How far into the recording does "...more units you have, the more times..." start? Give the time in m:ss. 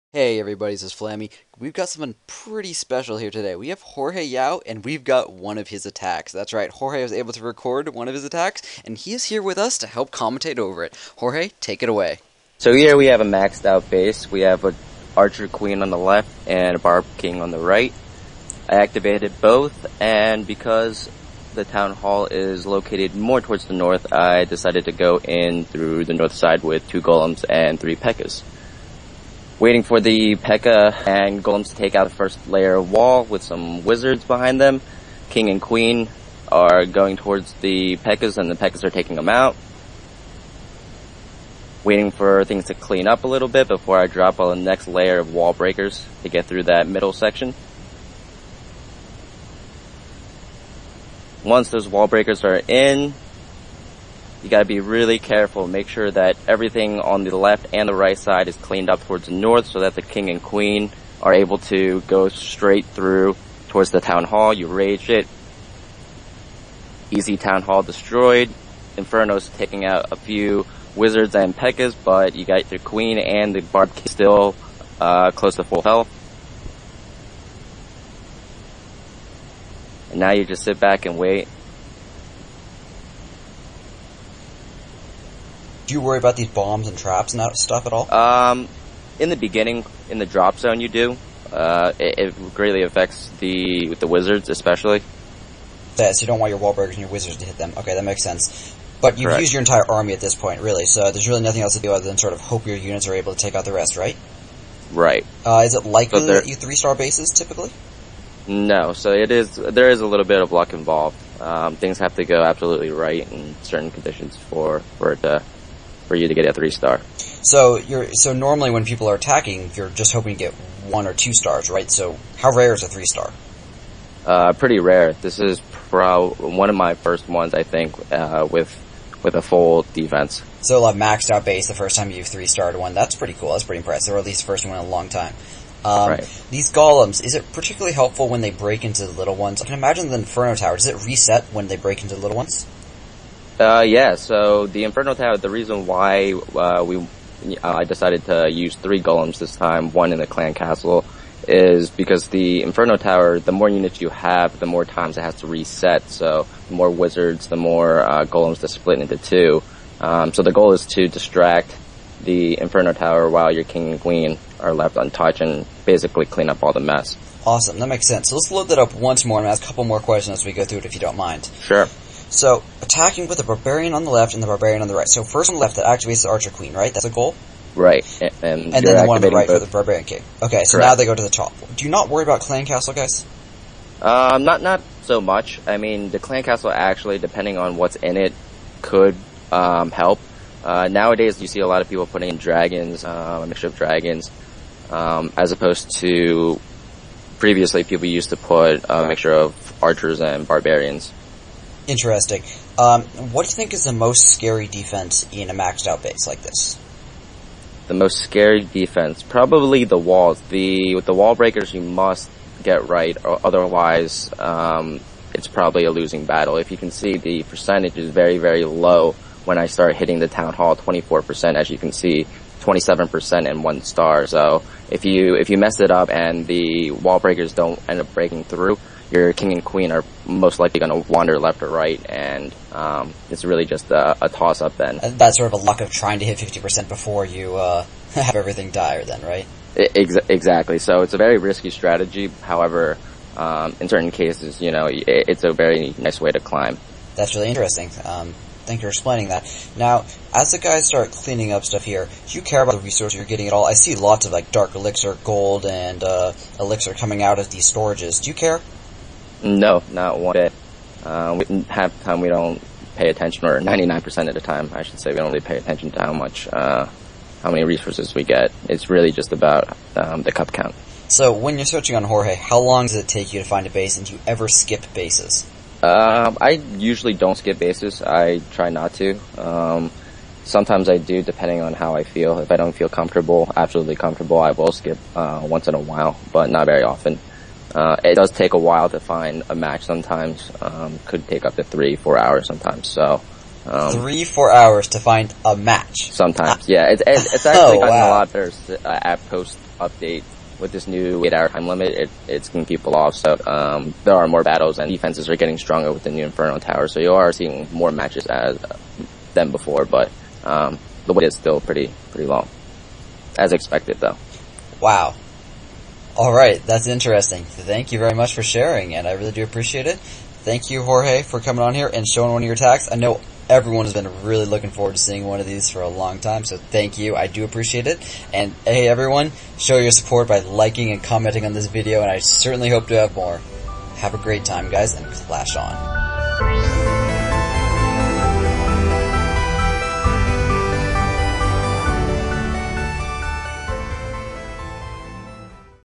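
2:33.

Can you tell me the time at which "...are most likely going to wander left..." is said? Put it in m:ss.
3:49.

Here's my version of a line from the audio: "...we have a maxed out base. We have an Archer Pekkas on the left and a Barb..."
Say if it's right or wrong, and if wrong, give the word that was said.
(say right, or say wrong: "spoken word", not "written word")
wrong: "Queen", not "Pekkas".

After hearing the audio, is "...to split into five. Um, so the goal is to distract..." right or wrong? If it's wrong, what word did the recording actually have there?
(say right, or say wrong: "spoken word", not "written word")
wrong: "two", not "five".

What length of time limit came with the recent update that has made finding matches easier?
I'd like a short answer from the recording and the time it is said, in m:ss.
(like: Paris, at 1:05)
8 hours, at 5:01.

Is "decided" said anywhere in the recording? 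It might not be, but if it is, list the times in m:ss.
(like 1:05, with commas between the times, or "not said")
0:24, 2:27.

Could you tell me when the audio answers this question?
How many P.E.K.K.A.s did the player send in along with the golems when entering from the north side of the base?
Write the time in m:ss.
0:27.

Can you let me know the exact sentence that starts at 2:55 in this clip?
So, first on the left, that activates the archer queen, right?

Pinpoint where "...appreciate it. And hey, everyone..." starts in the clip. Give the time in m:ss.
5:27.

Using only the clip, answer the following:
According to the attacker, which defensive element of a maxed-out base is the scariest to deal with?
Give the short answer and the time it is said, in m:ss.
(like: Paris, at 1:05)
The walls, at 3:29.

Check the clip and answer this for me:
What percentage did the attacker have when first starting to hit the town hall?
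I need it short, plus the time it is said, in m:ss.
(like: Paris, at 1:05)
24%, at 3:40.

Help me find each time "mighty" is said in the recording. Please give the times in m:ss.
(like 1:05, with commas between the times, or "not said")
not said.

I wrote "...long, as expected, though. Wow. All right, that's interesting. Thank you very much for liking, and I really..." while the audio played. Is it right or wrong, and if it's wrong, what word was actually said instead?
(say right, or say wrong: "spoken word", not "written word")
wrong: "sharing", not "liking".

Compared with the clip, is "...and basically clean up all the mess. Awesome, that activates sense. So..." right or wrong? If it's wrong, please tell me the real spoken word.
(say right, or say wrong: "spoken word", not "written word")
wrong: "makes", not "activates".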